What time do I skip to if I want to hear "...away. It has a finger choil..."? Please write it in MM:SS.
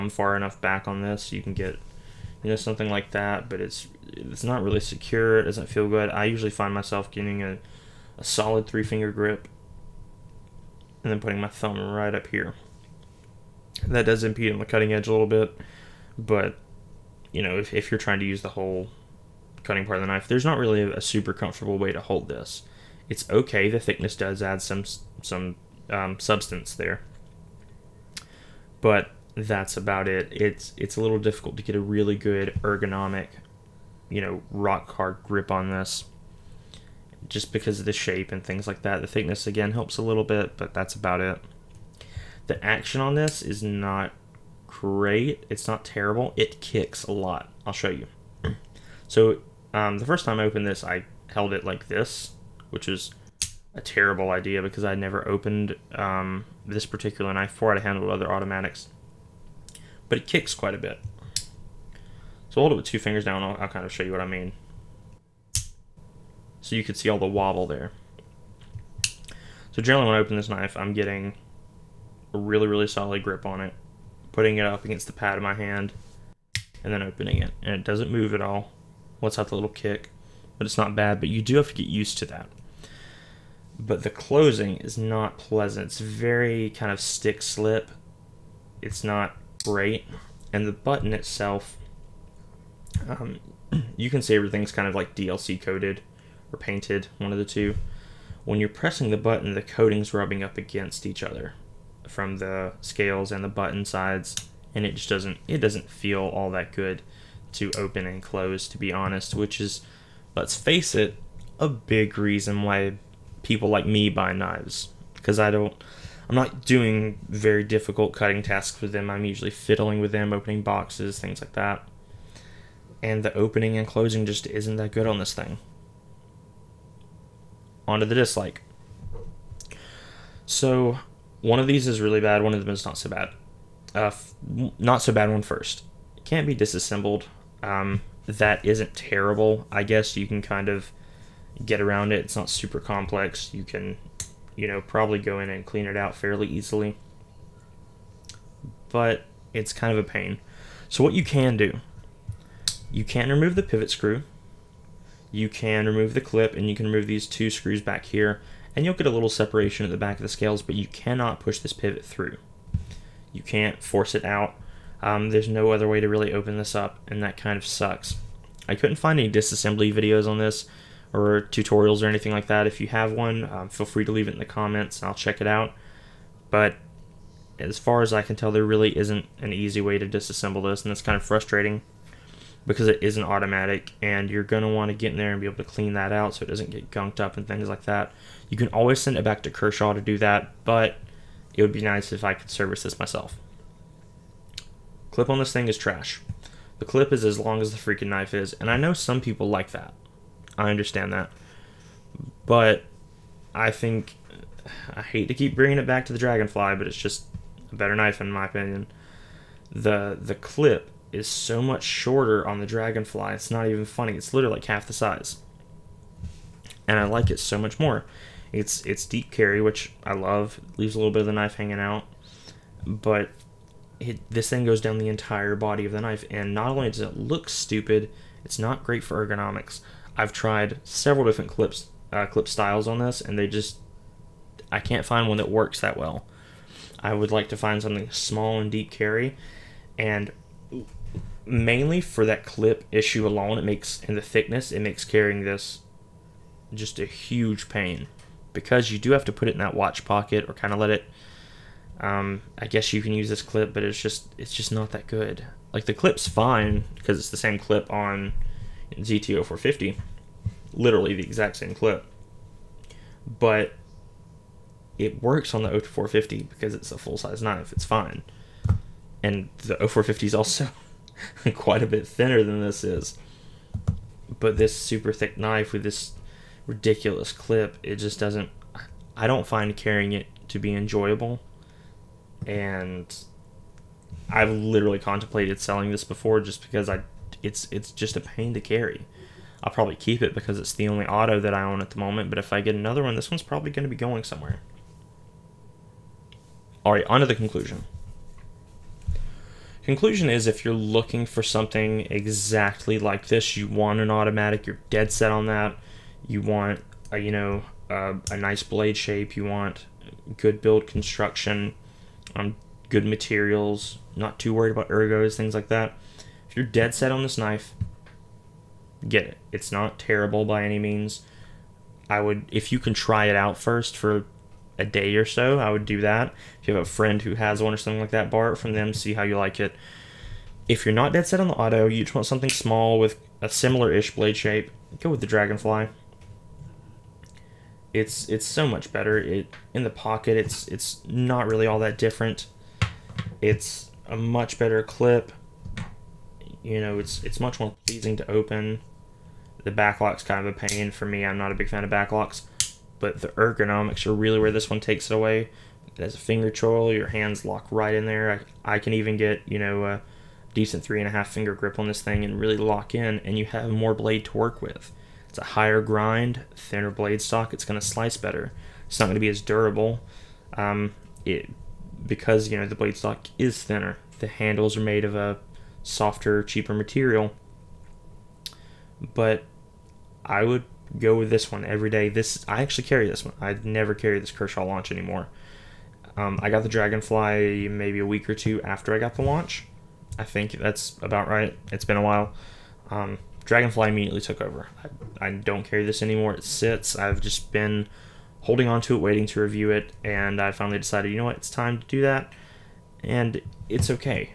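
05:55.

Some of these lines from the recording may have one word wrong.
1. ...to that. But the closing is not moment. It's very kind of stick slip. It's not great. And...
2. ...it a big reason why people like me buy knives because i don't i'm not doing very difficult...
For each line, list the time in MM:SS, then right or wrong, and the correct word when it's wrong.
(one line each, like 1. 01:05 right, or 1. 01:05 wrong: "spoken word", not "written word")
1. 01:22 wrong: "pleasant", not "moment"
2. 01:50 right.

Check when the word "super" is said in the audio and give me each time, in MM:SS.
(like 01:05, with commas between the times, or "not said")
00:21, 02:22, 04:34.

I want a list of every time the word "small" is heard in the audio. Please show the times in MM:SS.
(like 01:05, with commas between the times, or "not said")
03:58, 05:32.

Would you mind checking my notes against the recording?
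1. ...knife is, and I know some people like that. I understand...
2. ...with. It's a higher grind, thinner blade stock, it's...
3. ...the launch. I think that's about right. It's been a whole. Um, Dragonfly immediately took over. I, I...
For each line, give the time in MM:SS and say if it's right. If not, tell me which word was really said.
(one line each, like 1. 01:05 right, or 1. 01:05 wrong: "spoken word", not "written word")
1. 03:18 right
2. 06:04 right
3. 06:29 wrong: "while", not "whole".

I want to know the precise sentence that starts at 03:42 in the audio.
But it, this thing goes down the entire body of the knife.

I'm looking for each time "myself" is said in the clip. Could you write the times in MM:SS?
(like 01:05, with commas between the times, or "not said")
00:06, 03:12.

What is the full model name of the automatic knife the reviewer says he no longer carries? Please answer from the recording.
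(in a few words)
Kershaw Launch.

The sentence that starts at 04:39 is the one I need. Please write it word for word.
I don't find carrying it to be enjoyable.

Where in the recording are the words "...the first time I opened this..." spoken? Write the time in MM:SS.
00:49.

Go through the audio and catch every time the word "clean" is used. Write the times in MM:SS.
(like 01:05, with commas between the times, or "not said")
02:25, 03:05.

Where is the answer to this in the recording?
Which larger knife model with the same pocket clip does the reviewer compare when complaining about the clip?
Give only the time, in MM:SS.
04:18.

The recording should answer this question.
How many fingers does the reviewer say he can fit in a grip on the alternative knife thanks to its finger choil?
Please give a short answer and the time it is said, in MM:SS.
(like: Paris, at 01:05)
3.5, at 06:00.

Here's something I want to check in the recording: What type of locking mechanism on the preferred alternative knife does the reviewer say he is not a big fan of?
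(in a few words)
Backlock.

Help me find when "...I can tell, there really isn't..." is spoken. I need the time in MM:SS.
02:58.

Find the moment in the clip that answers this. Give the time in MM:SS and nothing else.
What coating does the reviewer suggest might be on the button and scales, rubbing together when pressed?
01:35.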